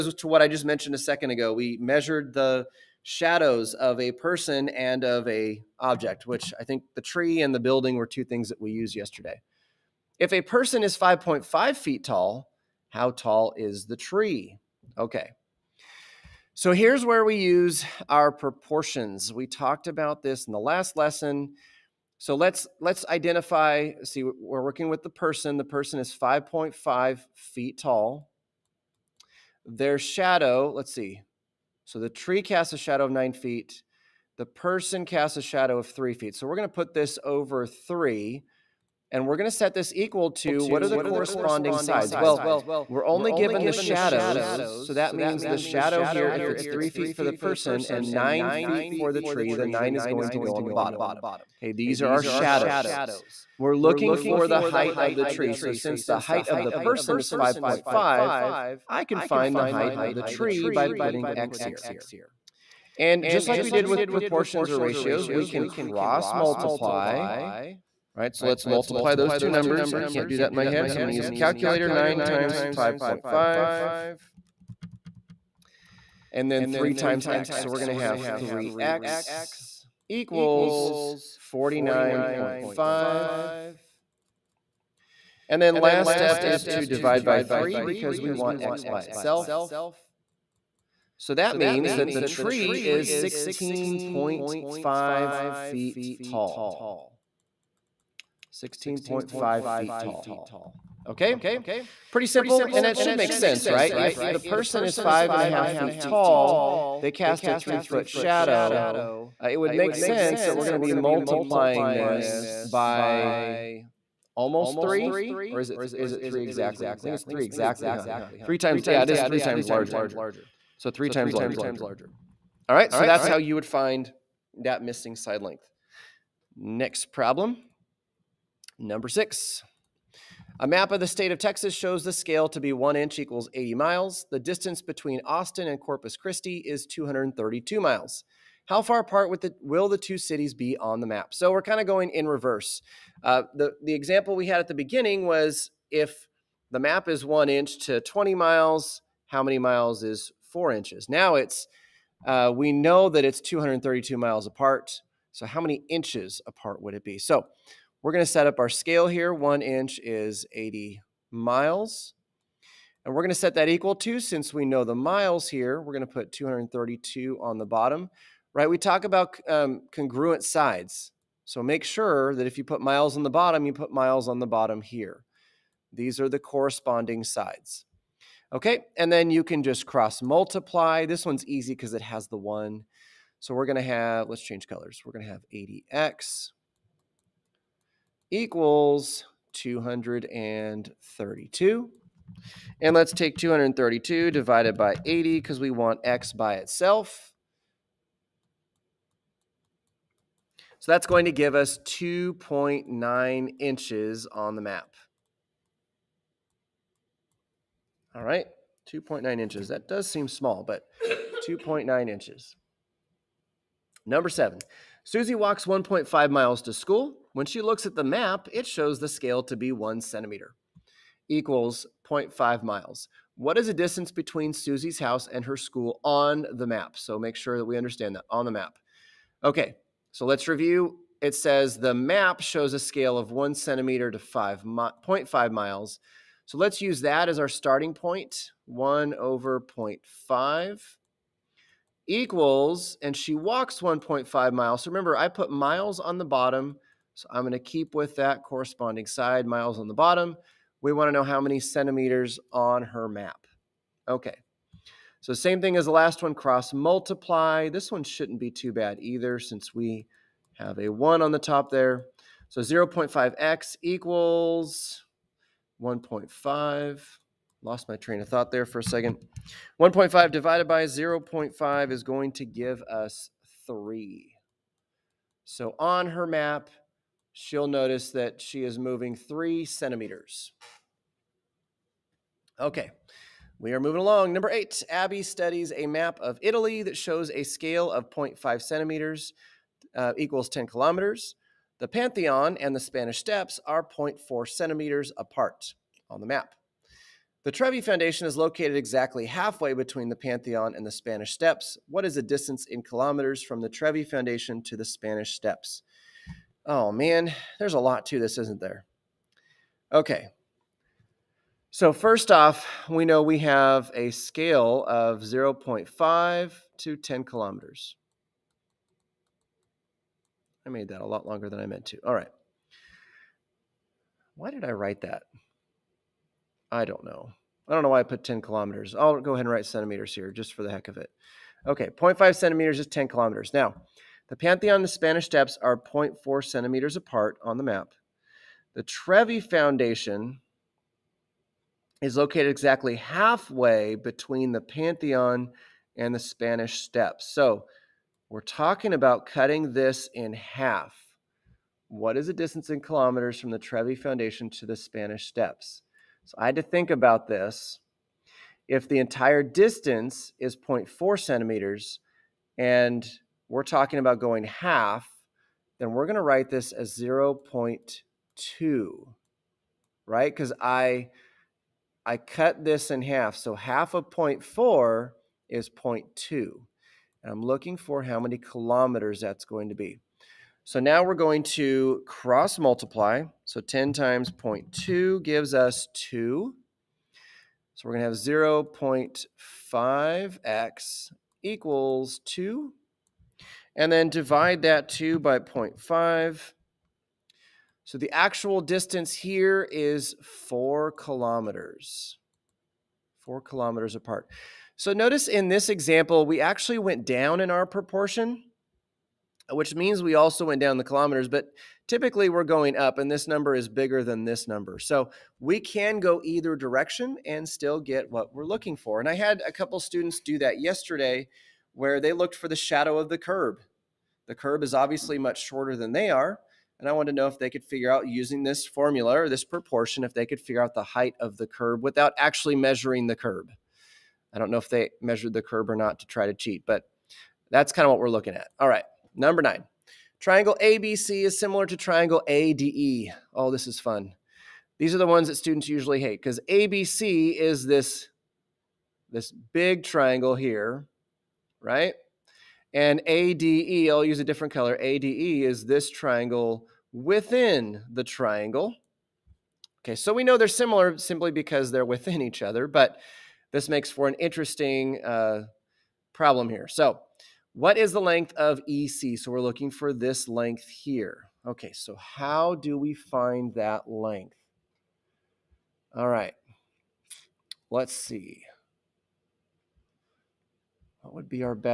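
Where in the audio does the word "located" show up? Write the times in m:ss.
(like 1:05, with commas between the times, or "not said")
4:58, 5:42.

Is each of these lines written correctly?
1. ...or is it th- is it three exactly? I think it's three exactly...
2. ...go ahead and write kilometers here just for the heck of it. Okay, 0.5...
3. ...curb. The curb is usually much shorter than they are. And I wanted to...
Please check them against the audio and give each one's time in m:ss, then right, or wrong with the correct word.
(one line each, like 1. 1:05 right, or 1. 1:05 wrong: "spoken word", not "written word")
1. 1:55 right
2. 5:29 wrong: "centimeters", not "kilometers"
3. 7:03 wrong: "obviously", not "usually".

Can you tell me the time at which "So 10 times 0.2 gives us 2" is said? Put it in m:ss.
6:23.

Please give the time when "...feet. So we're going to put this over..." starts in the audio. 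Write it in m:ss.
0:36.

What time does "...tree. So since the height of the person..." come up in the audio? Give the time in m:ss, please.
0:55.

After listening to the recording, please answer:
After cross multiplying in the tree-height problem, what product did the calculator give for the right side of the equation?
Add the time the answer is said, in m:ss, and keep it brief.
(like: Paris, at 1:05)
49.5, at 1:21.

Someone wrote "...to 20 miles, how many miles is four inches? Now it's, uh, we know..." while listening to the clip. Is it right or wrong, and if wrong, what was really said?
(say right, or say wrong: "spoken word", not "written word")
right.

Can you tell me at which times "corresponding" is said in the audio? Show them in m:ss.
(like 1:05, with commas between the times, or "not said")
0:40, 2:56, 4:08.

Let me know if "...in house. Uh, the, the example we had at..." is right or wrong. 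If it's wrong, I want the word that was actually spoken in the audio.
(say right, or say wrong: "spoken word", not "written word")
wrong: "reverse", not "house".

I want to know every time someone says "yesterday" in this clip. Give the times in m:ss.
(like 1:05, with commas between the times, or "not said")
0:08, 7:00.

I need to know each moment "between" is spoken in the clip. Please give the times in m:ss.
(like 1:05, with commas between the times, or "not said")
2:14, 3:44, 4:59, 5:43.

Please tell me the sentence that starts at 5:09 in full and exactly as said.
Okay, so first off, we know we have a scale of 0.5 to 10 kilometers.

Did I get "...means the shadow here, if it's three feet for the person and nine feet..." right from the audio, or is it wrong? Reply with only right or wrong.
right.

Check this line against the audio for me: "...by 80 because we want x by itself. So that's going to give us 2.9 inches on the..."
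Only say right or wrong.
right.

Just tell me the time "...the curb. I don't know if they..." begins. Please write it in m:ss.
7:13.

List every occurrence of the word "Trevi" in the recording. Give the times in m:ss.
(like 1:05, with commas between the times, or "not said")
4:57, 5:03, 5:38, 5:53.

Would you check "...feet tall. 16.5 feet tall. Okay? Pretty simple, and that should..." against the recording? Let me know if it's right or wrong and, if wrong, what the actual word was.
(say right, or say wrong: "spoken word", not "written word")
right.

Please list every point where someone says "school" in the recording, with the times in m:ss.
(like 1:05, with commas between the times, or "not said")
3:36, 3:45.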